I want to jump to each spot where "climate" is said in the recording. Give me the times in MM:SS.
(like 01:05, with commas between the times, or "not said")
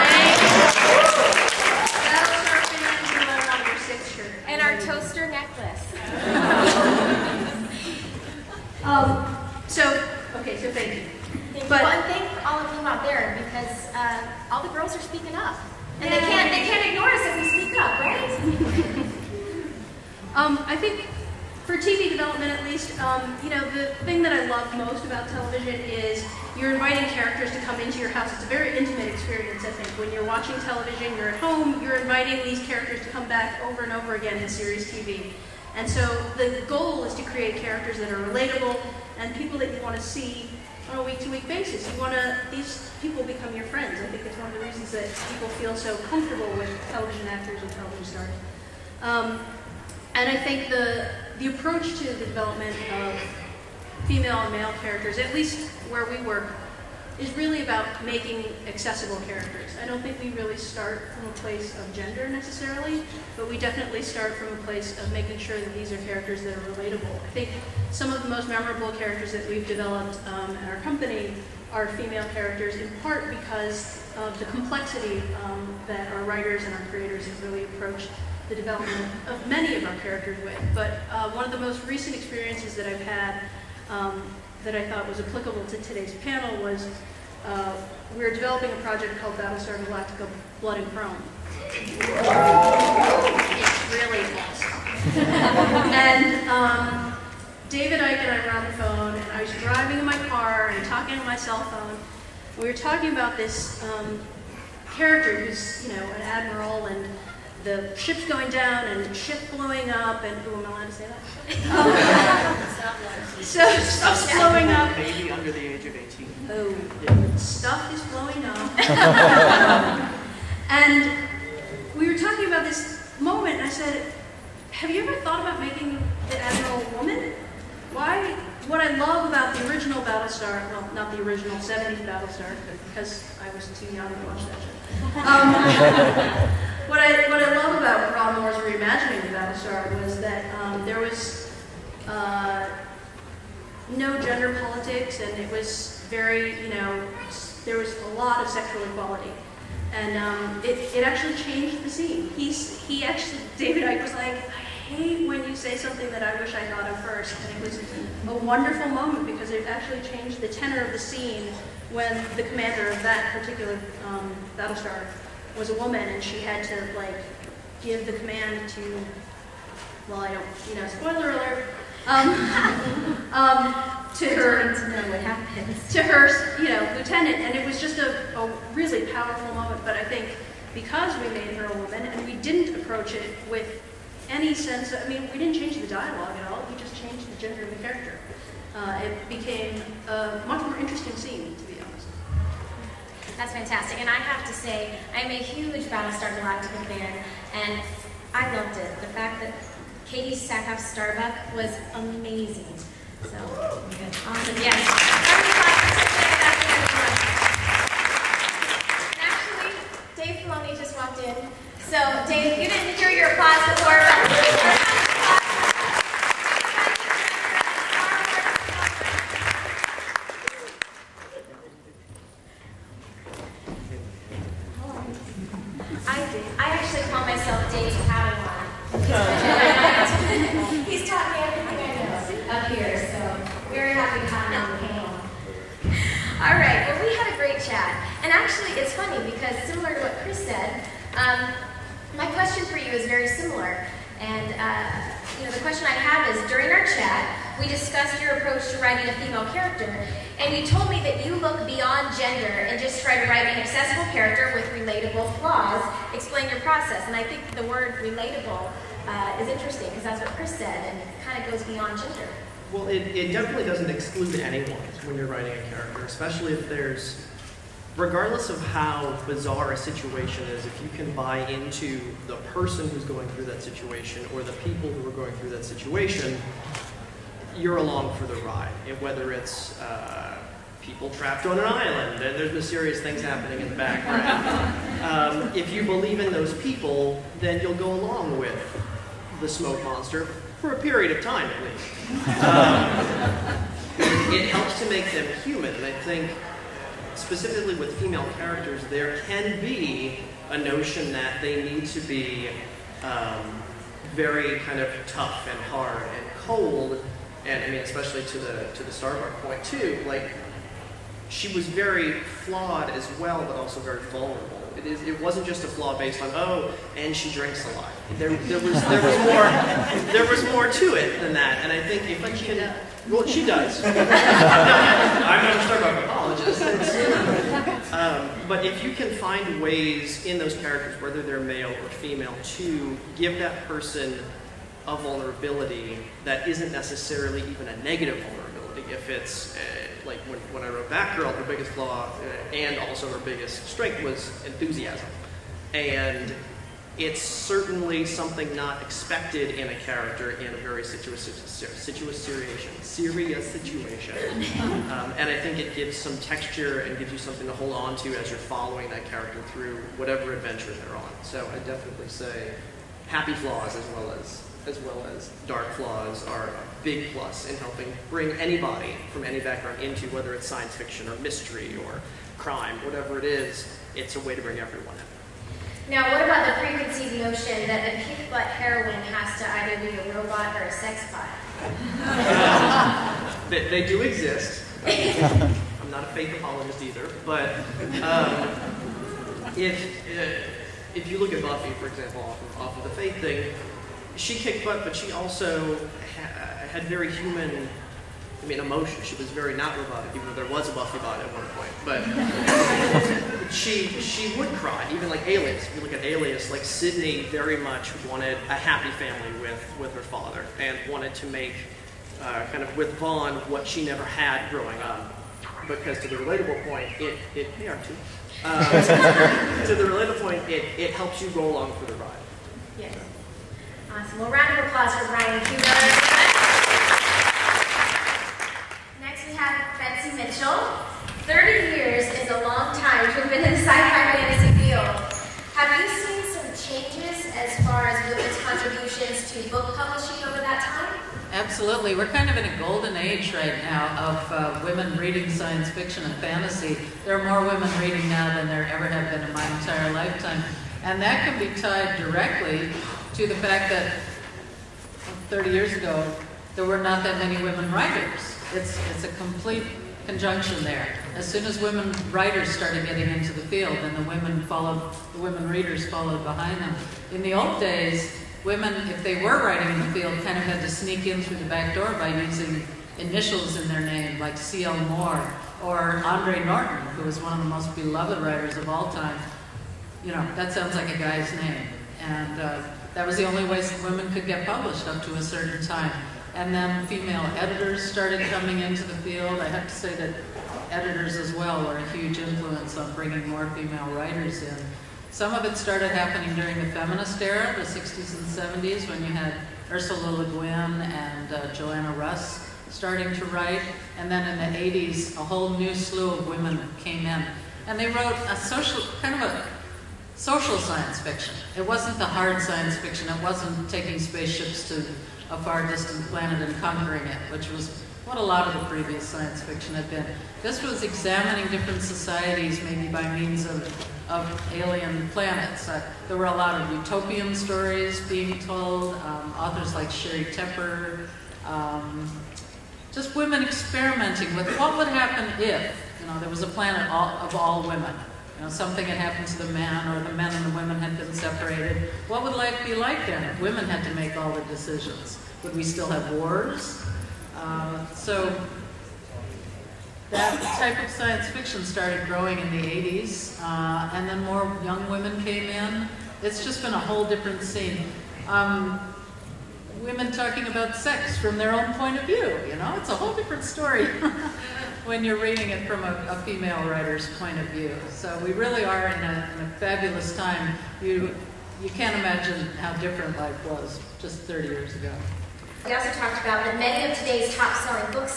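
not said.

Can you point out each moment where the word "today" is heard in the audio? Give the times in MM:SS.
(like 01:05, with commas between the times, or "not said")
01:25, 09:36.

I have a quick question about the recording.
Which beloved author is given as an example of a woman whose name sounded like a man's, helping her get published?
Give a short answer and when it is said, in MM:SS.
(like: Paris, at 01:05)
Andre Norton, at 07:56.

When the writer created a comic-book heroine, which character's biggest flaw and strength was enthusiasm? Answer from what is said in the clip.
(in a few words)
Batgirl.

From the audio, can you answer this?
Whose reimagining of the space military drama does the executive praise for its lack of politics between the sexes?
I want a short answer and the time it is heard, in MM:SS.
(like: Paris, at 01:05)
Ron Moore, at 02:18.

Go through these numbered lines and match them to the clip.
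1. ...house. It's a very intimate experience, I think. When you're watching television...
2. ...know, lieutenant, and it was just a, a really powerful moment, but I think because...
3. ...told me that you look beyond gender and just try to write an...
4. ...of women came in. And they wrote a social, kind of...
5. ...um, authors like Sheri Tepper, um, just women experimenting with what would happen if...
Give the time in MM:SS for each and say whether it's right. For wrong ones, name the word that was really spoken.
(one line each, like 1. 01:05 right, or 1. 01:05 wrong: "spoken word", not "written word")
1. 00:28 right
2. 02:56 right
3. 04:10 right
4. 08:26 right
5. 08:48 right.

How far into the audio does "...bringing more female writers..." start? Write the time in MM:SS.
08:12.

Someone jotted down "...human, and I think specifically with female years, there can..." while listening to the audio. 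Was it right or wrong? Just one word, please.
wrong.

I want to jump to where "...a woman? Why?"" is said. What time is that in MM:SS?
02:06.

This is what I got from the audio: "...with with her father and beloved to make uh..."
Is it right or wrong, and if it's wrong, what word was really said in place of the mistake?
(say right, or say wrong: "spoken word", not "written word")
wrong: "wanted", not "beloved".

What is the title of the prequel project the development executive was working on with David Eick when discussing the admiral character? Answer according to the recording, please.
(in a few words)
Blood and Chrome.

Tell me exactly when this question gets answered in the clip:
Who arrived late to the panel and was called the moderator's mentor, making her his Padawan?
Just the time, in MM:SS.
03:30.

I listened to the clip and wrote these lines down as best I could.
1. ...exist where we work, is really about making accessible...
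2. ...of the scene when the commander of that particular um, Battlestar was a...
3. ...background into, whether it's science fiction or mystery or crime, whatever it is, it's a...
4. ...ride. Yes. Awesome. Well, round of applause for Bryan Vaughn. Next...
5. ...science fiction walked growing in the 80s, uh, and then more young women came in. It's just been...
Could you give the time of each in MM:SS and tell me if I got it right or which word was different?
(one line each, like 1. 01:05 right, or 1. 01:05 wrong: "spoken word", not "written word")
1. 00:55 wrong: "least", not "exist"
2. 02:40 right
3. 06:09 right
4. 07:01 wrong: "Huber", not "Vaughn"
5. 09:10 wrong: "started", not "walked".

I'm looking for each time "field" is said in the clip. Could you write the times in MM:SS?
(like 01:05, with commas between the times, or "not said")
07:14, 07:43, 07:50, 08:08.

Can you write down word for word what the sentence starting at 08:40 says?
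This was examining different societies, maybe by means of, of alien planets.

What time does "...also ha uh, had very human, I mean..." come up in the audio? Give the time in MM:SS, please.
06:35.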